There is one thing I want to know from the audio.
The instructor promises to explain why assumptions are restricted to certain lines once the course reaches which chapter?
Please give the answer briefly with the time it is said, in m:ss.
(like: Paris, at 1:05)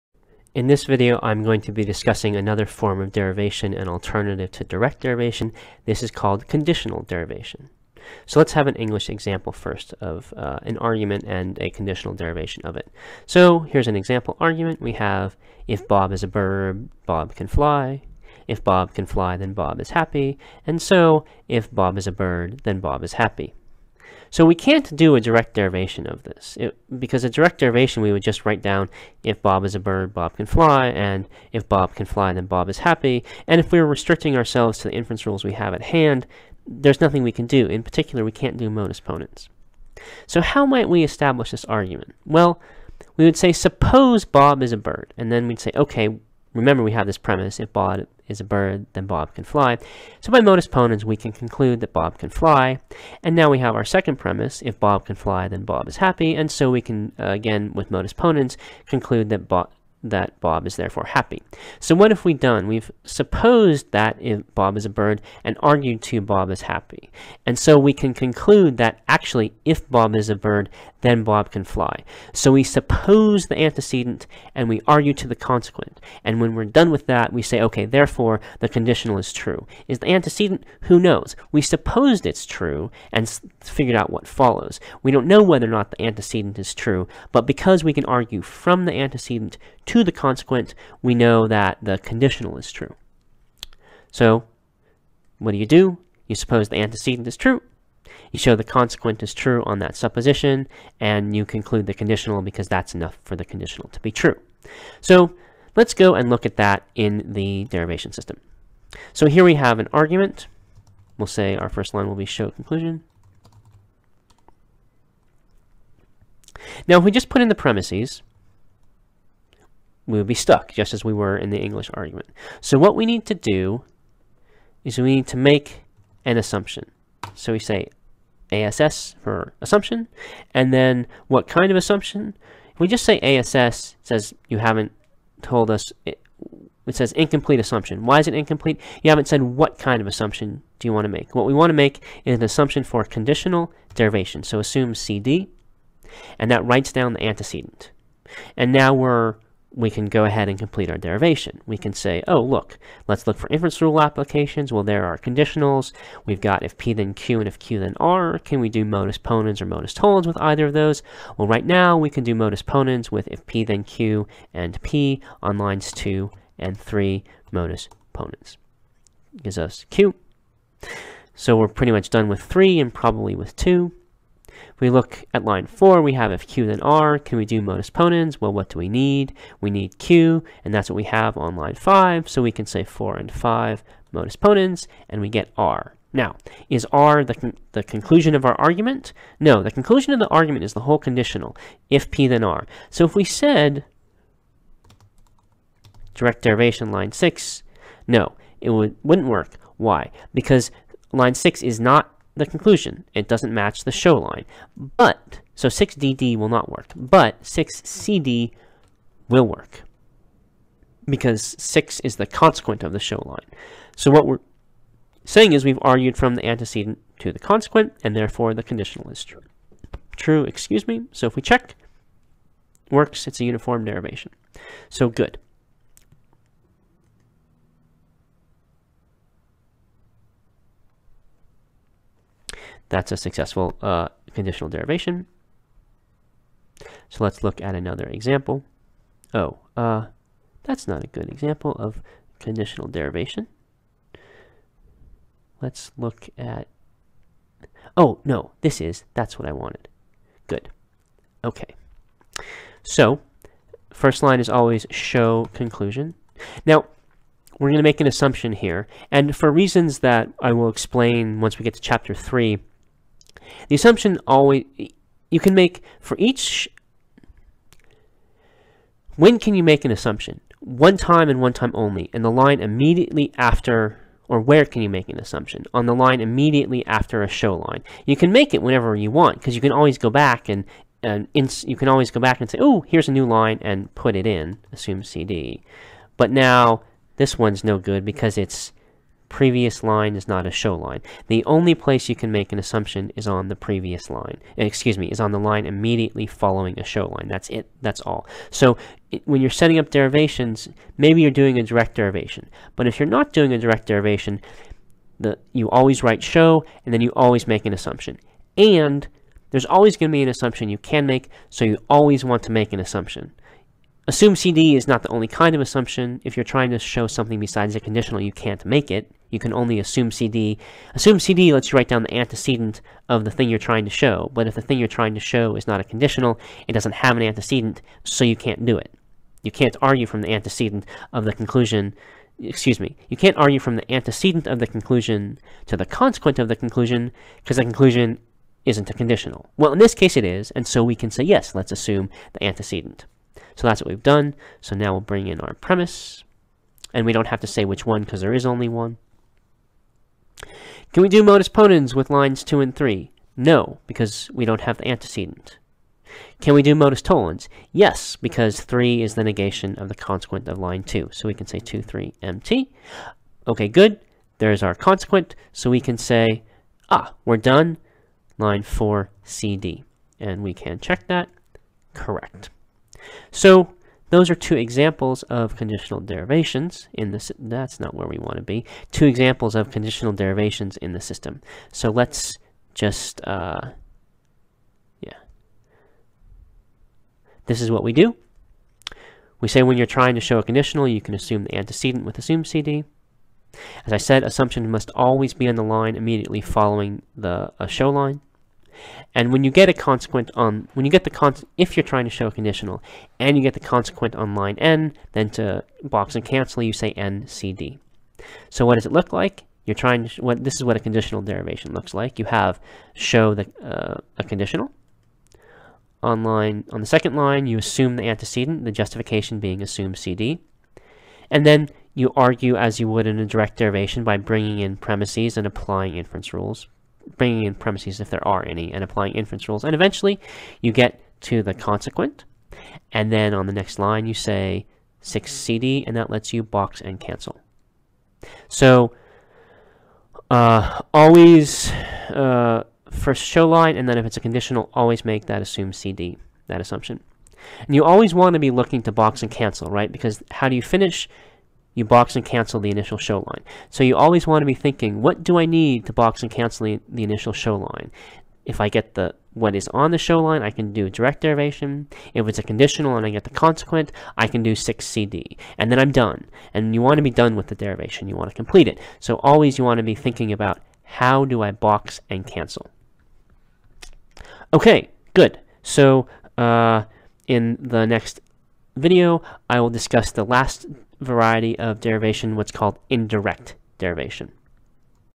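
chapter three, at 4:21.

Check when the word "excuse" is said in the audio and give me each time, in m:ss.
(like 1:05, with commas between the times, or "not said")
3:40, 4:54, 5:32.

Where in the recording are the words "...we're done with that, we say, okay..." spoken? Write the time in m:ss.
1:16.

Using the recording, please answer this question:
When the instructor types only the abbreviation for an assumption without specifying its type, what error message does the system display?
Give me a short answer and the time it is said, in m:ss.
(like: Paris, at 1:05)
incomplete assumption, at 2:17.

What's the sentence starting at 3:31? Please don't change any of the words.
Because 6 is the consequent of the show line.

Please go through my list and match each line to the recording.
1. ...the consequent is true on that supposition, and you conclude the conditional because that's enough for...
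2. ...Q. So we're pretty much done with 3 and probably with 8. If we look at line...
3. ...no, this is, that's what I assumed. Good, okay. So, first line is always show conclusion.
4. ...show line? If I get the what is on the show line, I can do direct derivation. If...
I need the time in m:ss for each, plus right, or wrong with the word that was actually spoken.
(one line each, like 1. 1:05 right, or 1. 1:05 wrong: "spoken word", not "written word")
1. 1:38 right
2. 2:49 wrong: "2", not "8"
3. 4:08 wrong: "wanted", not "assumed"
4. 7:37 right.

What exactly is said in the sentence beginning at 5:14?
Assume CD is not the only kind of assumption.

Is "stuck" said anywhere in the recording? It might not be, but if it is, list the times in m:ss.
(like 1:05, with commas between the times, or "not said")
2:00.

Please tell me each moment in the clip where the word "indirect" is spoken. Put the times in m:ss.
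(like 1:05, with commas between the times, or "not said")
8:02.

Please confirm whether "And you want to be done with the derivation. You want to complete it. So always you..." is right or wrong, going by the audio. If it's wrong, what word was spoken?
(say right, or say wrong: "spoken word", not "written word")
right.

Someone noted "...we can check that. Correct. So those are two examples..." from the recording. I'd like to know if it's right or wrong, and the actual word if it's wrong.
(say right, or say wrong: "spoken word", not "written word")
right.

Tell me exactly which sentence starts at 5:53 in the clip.
No, because we don't have the antecedent.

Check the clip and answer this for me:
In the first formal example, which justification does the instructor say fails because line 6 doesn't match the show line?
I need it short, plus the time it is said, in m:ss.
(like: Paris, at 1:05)
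6DD, at 3:25.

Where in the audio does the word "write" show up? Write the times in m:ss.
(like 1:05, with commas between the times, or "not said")
0:28, 2:26, 5:06, 5:21.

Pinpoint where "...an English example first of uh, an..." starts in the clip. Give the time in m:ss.
0:08.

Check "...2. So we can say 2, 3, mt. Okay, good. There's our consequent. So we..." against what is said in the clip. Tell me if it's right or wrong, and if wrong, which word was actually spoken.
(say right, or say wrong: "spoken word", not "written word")
right.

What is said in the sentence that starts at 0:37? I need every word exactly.
In particular, we can't do modus ponens.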